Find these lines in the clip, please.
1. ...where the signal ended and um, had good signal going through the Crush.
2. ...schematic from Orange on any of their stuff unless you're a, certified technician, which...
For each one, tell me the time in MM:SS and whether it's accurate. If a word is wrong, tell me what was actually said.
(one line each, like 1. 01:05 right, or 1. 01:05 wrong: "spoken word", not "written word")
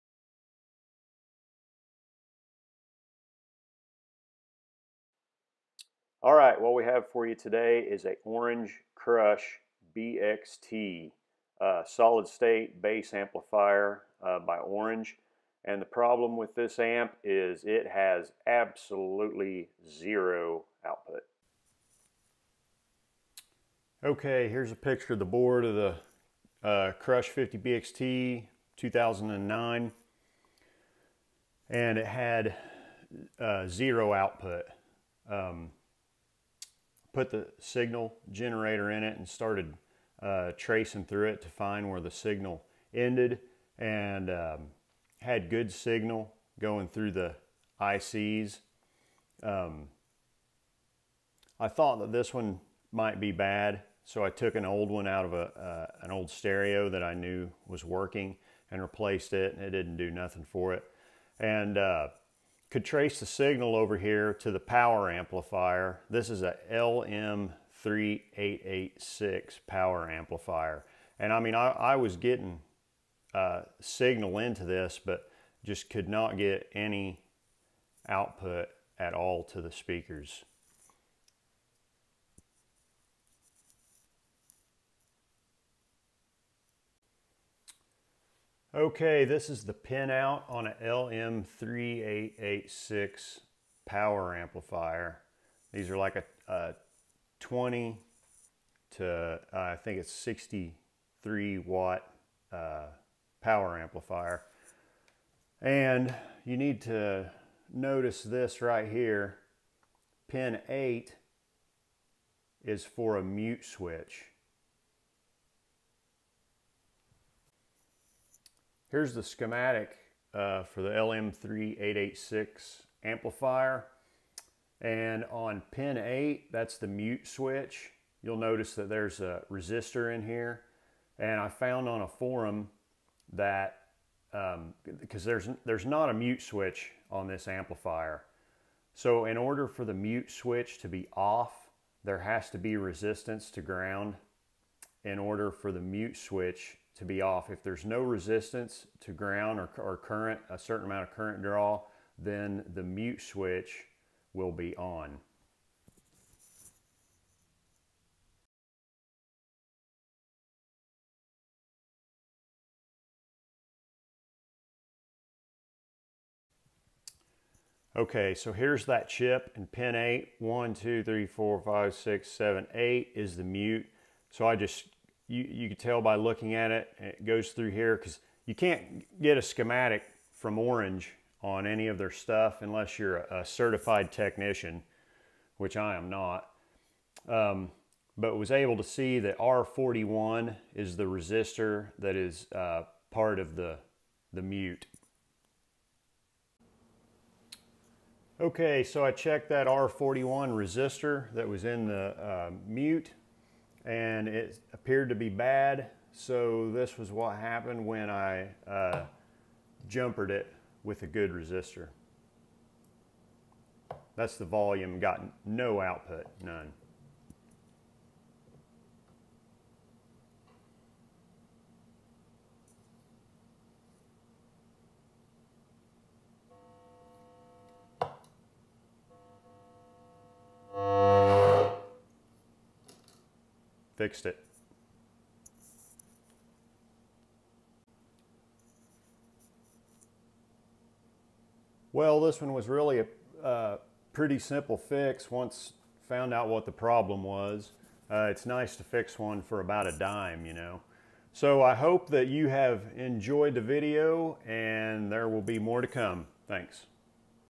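1. 00:41 wrong: "ICs", not "Crush"
2. 02:59 right.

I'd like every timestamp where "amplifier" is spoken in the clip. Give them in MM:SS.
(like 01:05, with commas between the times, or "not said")
00:13, 01:05, 01:10, 01:34, 01:43, 02:03, 02:17.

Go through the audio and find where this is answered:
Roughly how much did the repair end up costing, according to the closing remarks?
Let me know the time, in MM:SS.
04:09.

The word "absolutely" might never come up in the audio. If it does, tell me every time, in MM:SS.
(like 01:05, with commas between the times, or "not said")
00:18.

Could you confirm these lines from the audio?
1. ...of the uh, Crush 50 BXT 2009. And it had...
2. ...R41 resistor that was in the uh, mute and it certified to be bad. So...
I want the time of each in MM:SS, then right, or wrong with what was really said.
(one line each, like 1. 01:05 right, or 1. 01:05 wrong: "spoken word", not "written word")
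1. 00:25 right
2. 03:19 wrong: "appeared", not "certified".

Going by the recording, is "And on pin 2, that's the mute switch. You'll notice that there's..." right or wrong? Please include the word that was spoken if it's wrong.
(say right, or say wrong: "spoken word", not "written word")
wrong: "8", not "2".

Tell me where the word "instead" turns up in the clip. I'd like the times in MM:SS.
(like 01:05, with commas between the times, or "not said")
not said.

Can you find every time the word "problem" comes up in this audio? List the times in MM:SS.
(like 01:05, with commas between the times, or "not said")
00:15, 04:06.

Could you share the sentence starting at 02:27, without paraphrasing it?
If there's no resistance to ground or, or current, a certain amount of current draw, then the mute switch will be on.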